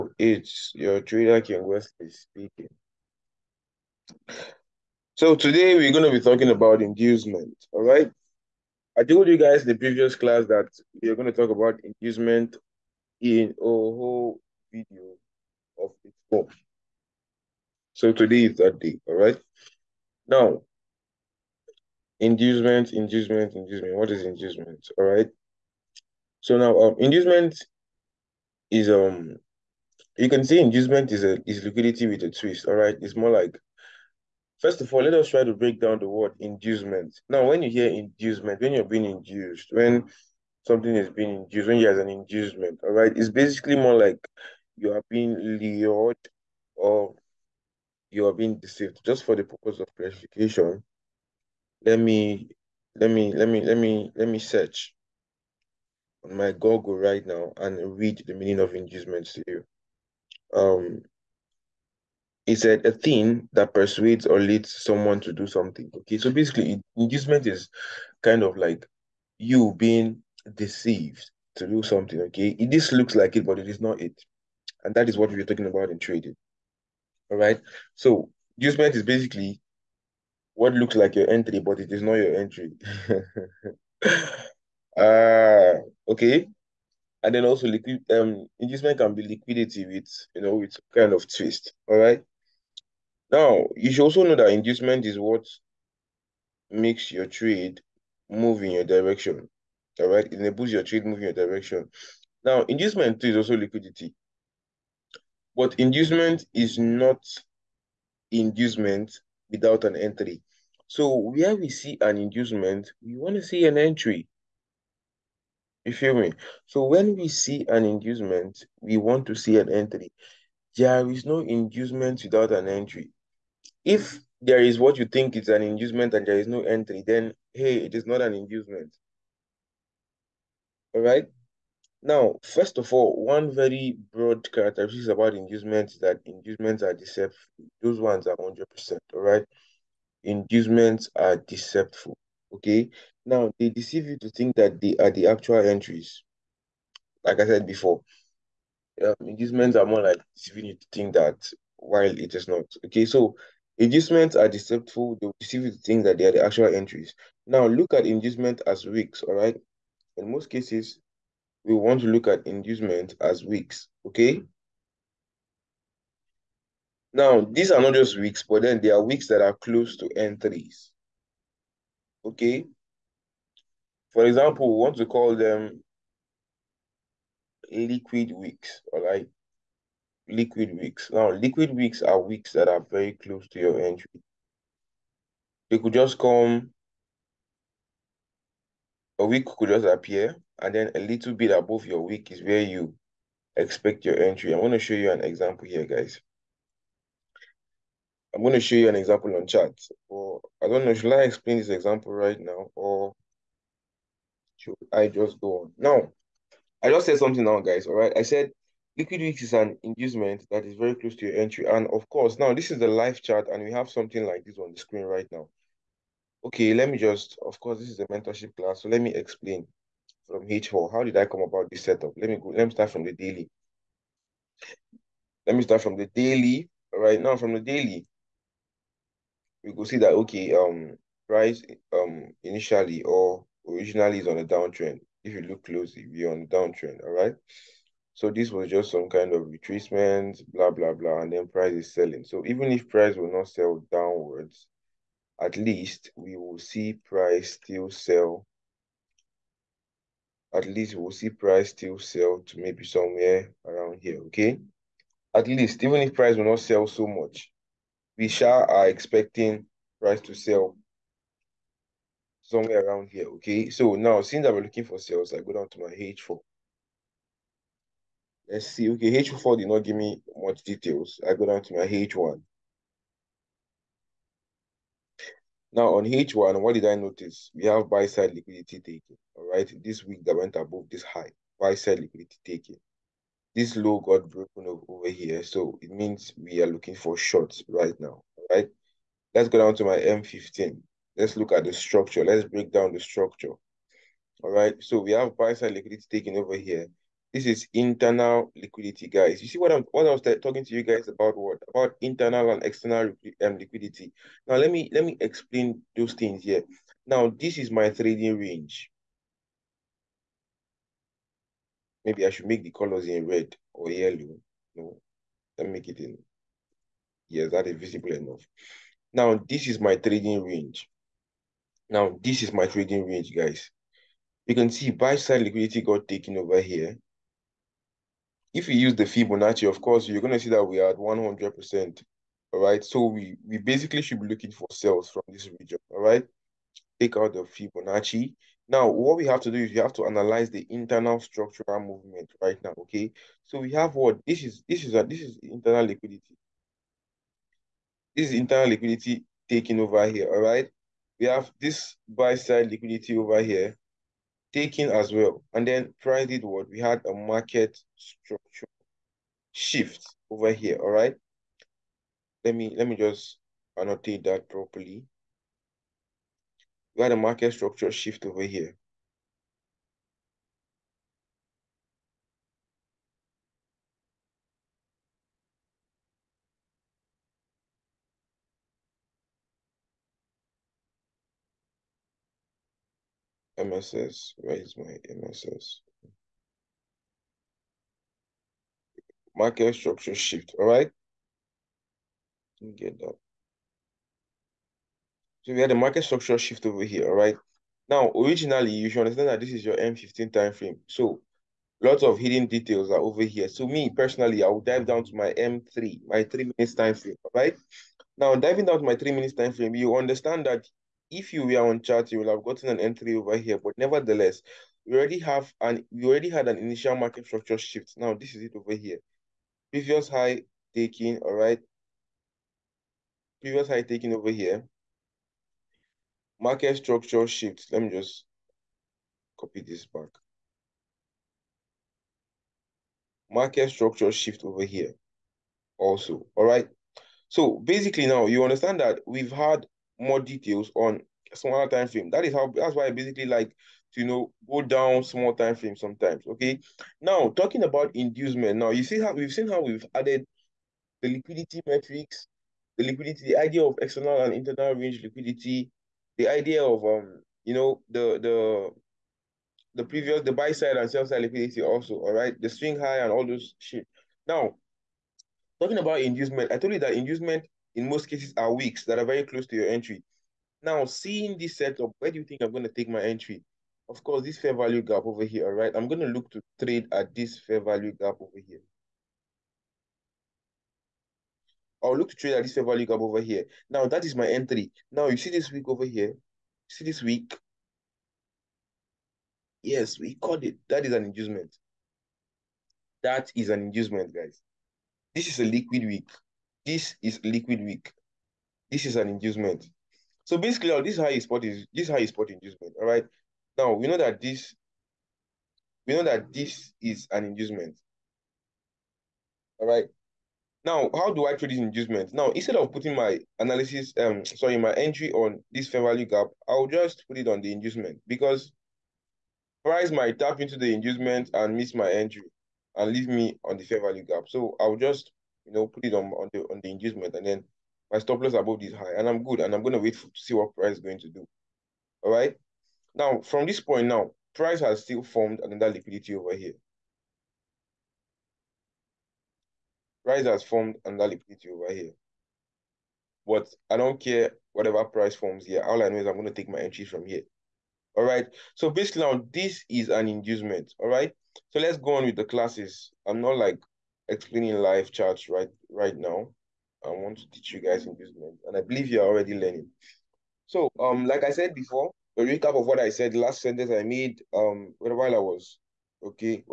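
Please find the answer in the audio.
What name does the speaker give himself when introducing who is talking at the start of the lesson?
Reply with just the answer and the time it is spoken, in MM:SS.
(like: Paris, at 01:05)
King Wesley, at 00:01.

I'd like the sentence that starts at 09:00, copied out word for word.
Price has formed another liquidity over here.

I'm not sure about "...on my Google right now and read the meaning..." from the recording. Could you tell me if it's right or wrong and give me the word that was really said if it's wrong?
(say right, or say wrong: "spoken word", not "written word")
right.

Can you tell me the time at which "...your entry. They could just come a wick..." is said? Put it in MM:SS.
03:03.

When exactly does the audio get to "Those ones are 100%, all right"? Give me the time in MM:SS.
02:17.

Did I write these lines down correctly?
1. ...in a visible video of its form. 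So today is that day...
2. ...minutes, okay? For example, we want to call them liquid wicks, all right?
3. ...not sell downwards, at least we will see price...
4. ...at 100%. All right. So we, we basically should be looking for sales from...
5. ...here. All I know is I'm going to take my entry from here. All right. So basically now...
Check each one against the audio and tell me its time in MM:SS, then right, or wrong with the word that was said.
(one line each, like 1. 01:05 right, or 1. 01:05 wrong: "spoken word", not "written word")
1. 00:13 wrong: "whole", not "visible"
2. 02:50 wrong: "entries", not "minutes"
3. 04:03 right
4. 05:30 right
5. 09:05 right.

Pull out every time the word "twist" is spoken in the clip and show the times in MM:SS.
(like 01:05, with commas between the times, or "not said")
00:32, 01:31.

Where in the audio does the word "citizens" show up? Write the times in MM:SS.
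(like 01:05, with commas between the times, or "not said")
not said.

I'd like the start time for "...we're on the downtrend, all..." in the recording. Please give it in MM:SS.
03:56.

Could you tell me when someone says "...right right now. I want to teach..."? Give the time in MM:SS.
09:15.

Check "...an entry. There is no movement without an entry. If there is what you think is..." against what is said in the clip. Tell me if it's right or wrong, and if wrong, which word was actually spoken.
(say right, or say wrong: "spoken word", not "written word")
wrong: "inducement", not "movement".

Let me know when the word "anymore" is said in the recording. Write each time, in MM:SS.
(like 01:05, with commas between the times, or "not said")
not said.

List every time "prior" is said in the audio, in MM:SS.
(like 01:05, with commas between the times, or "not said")
05:55.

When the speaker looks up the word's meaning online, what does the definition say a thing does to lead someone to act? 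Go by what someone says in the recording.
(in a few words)
persuades.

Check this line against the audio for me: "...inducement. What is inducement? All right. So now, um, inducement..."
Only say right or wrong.
right.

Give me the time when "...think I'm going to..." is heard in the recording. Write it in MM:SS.
07:52.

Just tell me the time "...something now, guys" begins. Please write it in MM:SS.
03:27.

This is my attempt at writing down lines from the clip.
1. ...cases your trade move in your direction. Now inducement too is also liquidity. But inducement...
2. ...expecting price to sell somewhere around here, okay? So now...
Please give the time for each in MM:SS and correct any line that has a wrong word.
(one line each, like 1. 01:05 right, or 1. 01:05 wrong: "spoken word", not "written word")
1. 01:40 wrong: "enables", not "cases"
2. 04:18 right.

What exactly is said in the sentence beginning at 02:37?
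Now, look at inducement as wicks, all right?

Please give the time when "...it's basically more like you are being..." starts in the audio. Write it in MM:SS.
00:43.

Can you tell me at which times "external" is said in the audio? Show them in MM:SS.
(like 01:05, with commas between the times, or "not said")
05:02, 07:33.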